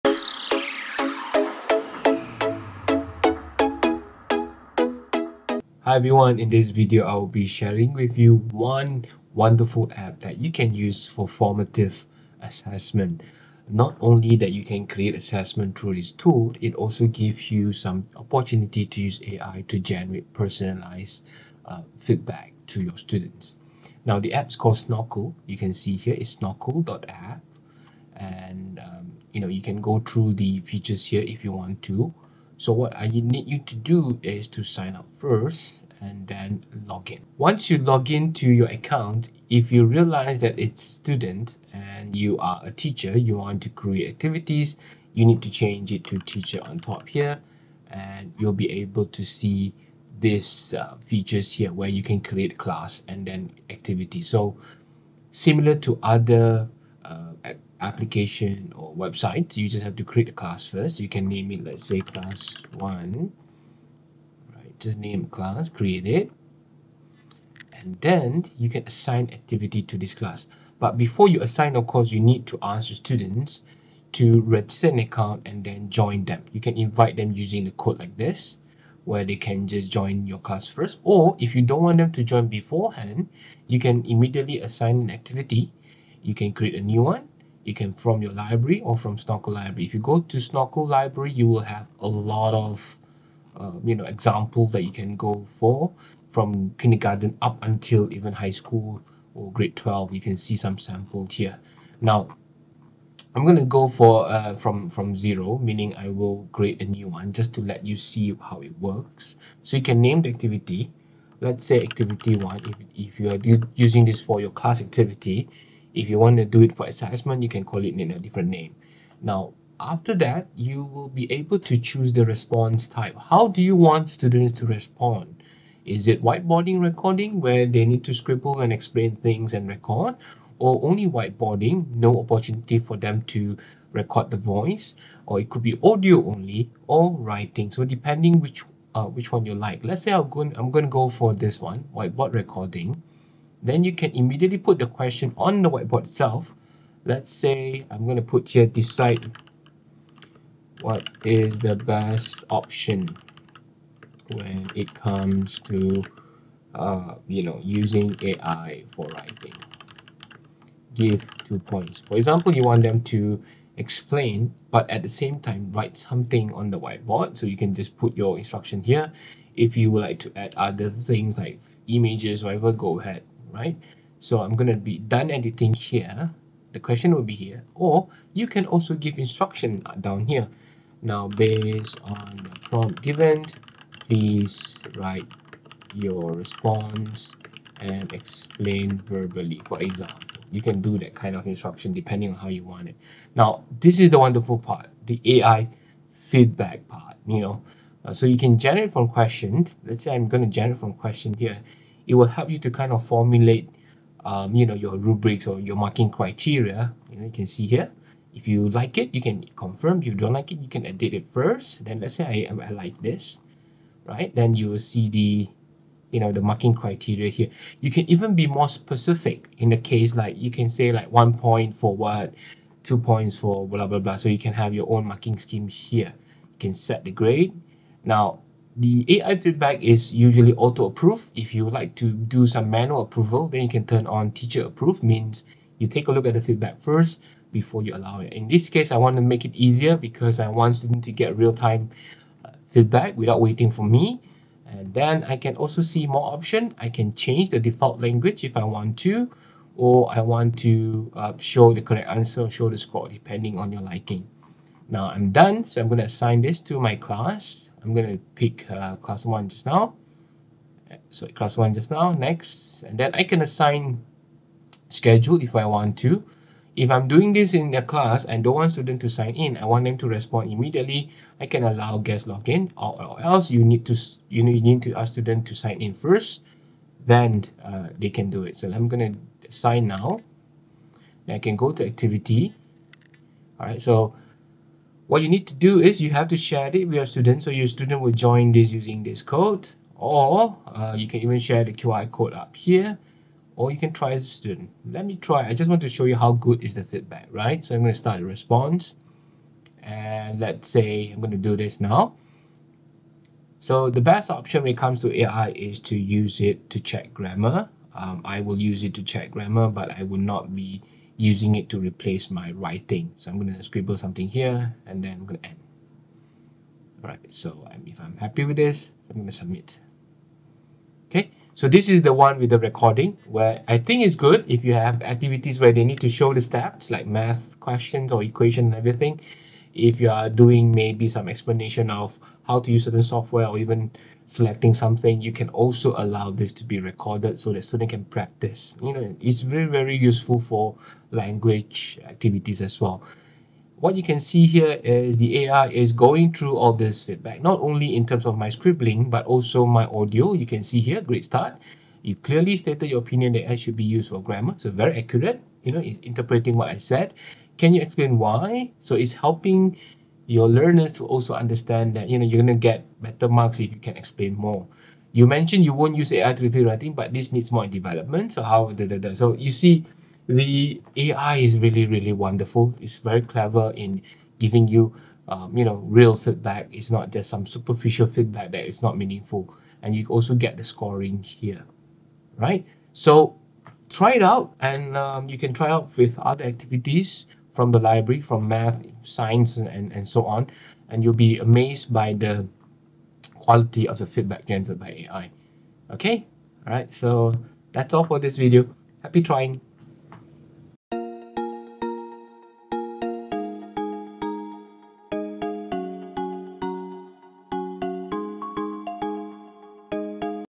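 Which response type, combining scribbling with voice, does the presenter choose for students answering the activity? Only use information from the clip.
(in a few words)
Whiteboard recording.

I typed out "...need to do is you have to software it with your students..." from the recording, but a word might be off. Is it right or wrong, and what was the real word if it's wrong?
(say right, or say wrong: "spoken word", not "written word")
wrong: "share", not "software".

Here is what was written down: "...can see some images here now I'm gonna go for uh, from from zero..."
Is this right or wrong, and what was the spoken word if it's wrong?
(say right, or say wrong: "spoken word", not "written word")
wrong: "samples", not "images".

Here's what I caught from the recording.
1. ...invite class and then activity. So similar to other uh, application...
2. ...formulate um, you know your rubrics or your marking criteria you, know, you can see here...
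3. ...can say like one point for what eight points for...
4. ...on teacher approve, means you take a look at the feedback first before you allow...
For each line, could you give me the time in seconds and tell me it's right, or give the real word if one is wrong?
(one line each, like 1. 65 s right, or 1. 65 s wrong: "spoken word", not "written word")
1. 52 s wrong: "create", not "invite"
2. 203 s right
3. 220 s wrong: "two", not "eight"
4. 234 s right.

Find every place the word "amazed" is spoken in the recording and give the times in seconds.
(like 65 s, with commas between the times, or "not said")
391 s.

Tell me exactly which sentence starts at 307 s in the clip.
Um, I will use it to check grammar, but I will not be using it to replace my writing.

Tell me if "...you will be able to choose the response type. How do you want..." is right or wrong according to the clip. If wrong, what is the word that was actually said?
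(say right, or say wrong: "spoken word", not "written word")
right.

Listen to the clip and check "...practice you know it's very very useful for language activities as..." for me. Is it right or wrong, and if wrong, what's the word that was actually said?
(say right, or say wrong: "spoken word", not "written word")
right.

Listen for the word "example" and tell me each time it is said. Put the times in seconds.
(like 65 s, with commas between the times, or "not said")
94 s, 162 s, 189 s.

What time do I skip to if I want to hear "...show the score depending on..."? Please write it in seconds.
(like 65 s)
252 s.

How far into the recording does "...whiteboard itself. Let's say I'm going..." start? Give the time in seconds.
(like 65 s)
145 s.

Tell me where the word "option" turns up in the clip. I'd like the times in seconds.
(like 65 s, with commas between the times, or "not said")
152 s, 246 s, 304 s.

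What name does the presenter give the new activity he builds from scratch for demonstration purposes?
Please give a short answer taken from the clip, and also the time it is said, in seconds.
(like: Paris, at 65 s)
Activity one, at 111 s.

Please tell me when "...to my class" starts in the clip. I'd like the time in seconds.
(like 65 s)
256 s.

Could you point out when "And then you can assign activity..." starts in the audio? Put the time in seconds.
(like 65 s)
67 s.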